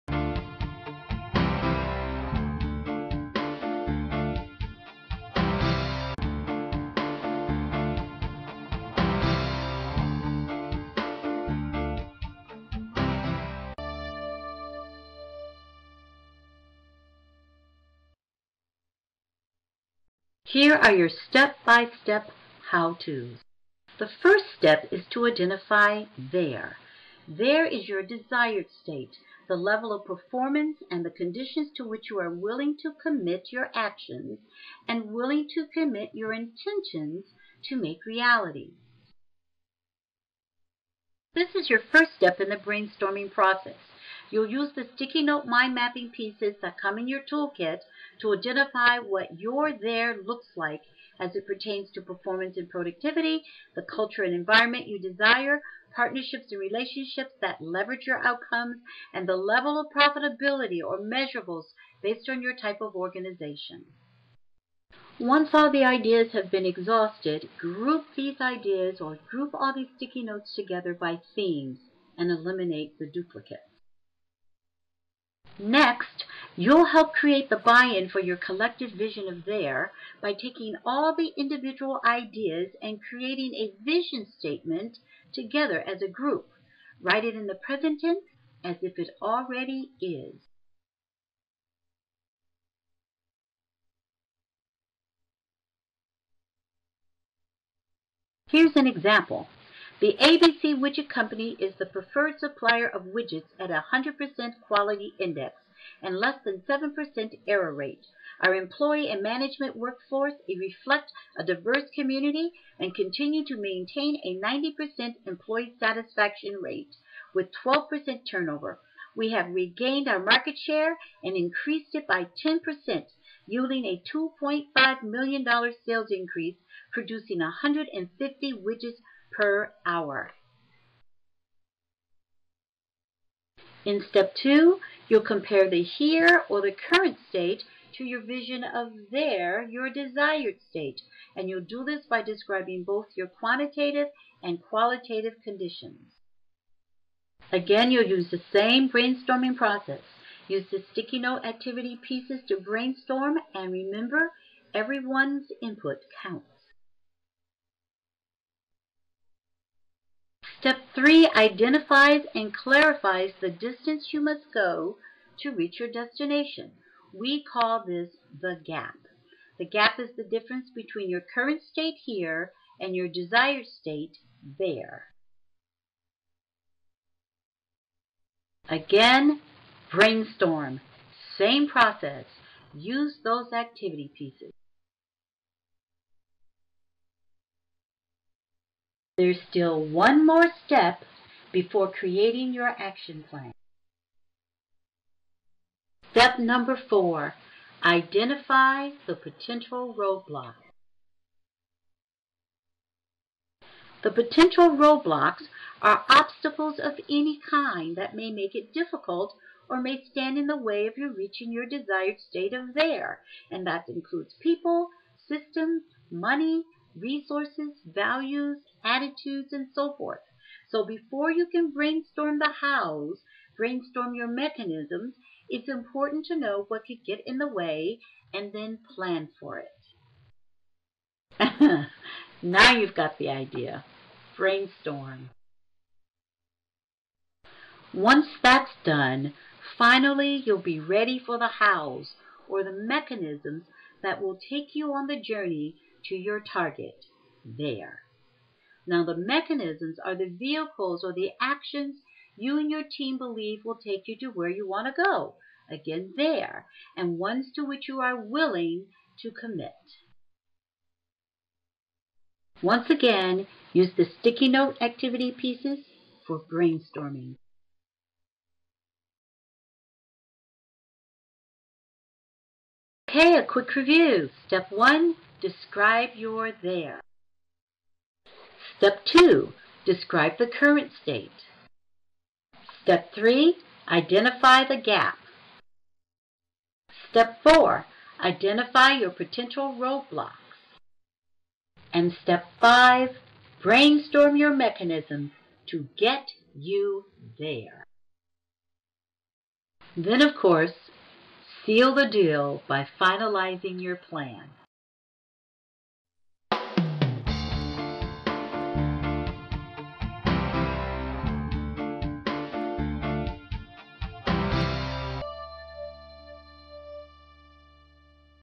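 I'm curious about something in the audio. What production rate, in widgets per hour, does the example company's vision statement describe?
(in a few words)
150.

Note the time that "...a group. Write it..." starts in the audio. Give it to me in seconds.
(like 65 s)
86 s.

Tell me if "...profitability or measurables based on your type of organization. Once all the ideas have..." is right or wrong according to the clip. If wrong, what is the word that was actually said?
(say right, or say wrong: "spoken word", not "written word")
right.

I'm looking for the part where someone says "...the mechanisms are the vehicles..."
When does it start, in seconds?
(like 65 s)
249 s.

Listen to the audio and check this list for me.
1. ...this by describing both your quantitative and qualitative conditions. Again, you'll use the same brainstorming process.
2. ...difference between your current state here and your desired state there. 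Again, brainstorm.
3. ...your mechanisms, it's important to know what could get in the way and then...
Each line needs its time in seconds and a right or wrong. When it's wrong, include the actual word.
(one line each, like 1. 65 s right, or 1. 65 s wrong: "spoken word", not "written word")
1. 141 s right
2. 170 s right
3. 224 s right.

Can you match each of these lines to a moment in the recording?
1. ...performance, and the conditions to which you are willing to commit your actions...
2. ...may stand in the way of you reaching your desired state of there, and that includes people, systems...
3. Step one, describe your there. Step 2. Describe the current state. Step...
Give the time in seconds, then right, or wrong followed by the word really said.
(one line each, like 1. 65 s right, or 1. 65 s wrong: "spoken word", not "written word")
1. 30 s right
2. 209 s right
3. 274 s right.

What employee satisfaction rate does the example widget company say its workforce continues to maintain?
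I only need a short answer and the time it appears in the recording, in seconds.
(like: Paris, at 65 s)
90%, at 114 s.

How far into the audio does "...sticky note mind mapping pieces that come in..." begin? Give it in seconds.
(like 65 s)
44 s.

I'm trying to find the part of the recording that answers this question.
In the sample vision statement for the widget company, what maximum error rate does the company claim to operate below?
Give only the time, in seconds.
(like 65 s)
106 s.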